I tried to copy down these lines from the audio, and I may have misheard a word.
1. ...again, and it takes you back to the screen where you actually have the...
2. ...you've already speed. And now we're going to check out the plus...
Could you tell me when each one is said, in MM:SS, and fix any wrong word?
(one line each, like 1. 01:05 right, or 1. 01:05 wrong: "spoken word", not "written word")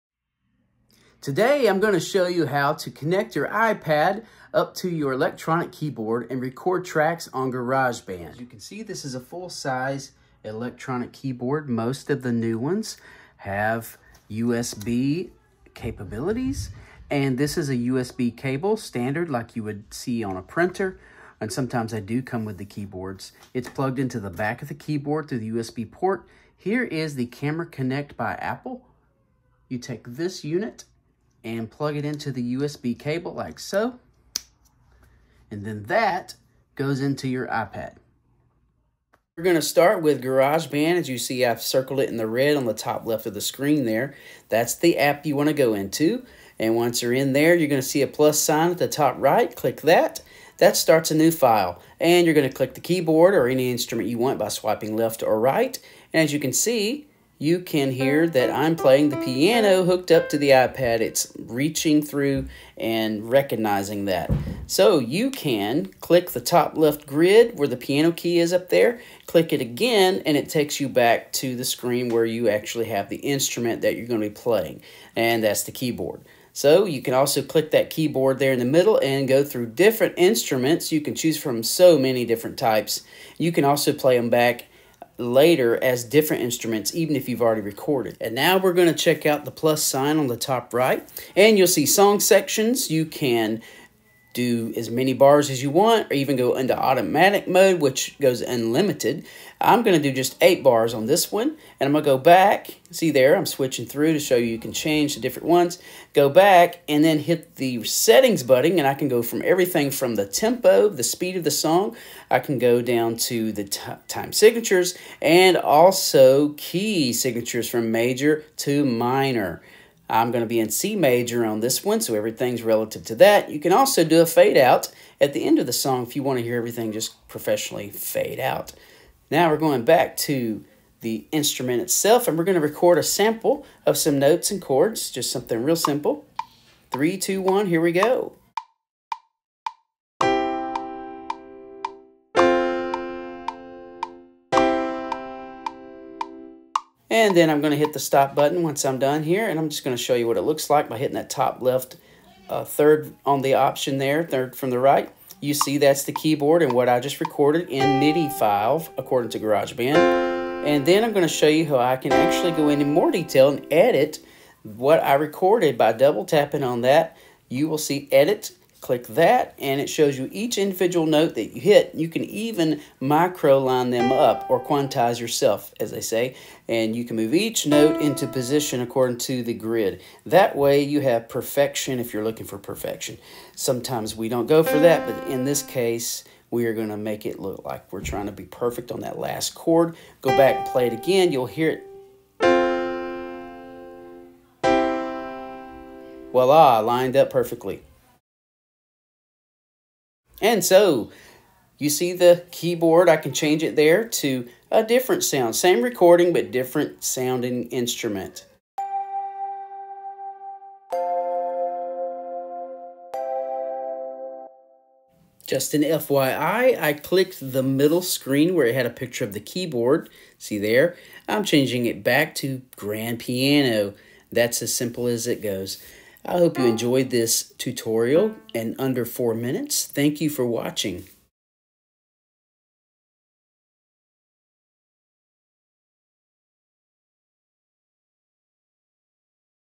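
1. 01:09 right
2. 01:27 wrong: "recorded", not "speed".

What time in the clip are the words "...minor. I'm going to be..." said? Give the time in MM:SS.
01:58.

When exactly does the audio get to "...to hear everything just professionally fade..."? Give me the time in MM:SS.
02:06.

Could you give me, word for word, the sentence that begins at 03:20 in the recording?
And so you see the keyboard, I can change it there to a different sound.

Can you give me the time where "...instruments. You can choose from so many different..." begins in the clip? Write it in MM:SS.
01:20.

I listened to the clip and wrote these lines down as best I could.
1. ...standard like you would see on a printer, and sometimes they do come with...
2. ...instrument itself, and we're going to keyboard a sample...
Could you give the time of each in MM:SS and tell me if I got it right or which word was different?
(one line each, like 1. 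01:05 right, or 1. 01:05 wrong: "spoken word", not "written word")
1. 00:18 right
2. 02:11 wrong: "record", not "keyboard".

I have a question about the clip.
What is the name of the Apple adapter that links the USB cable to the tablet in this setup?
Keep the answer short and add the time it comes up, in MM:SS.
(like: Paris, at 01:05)
Camera Connect, at 00:27.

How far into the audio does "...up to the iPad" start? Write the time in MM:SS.
01:00.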